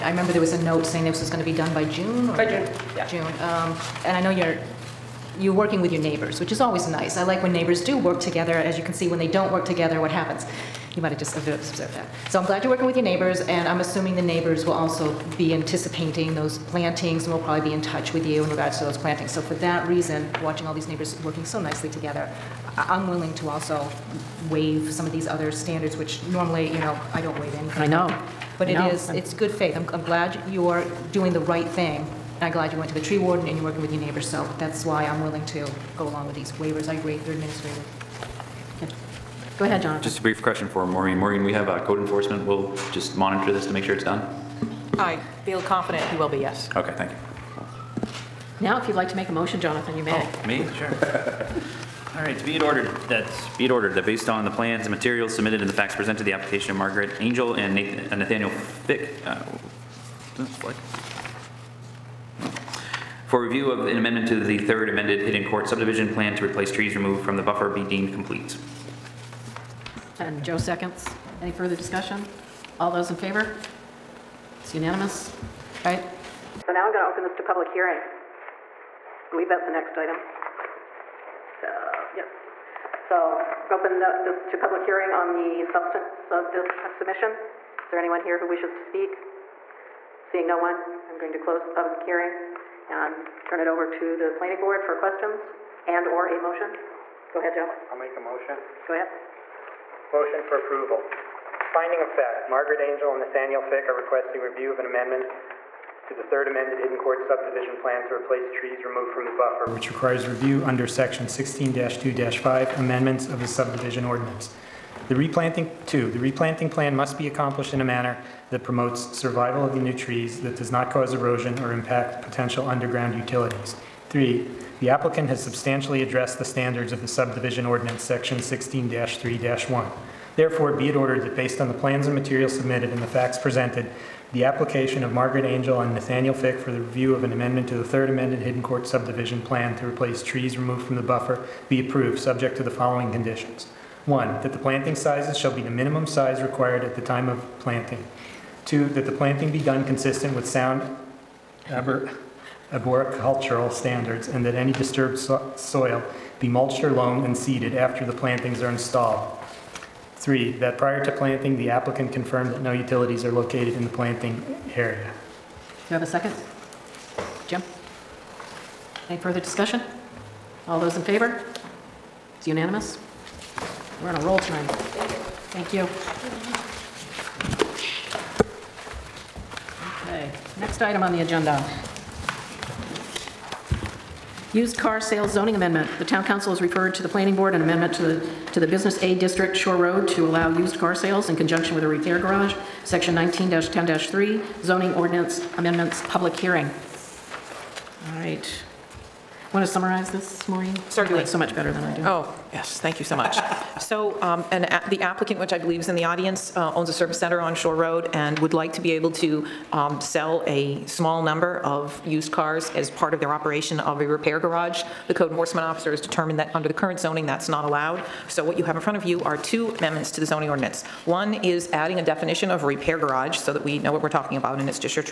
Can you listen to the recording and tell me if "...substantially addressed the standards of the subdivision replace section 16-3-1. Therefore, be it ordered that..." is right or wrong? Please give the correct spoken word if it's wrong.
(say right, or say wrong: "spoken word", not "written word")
wrong: "ordinance", not "replace".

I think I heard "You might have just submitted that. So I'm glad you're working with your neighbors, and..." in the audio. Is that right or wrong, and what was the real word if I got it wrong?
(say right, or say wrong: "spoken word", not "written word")
wrong: "observed", not "submitted".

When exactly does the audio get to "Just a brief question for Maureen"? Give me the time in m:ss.
0:40.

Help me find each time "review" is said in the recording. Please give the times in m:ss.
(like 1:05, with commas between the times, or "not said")
1:03, 1:44, 1:50, 2:16.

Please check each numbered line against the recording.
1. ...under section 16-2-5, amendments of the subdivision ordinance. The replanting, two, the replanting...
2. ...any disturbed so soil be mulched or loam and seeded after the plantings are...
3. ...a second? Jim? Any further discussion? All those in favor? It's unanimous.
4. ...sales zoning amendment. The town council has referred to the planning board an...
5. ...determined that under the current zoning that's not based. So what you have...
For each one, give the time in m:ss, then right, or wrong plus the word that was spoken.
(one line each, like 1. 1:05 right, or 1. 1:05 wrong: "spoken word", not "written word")
1. 1:50 right
2. 2:34 right
3. 2:46 right
4. 3:04 right
5. 3:35 wrong: "allowed", not "based".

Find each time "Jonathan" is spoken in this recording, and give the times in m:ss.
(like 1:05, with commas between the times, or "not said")
0:39, 0:49.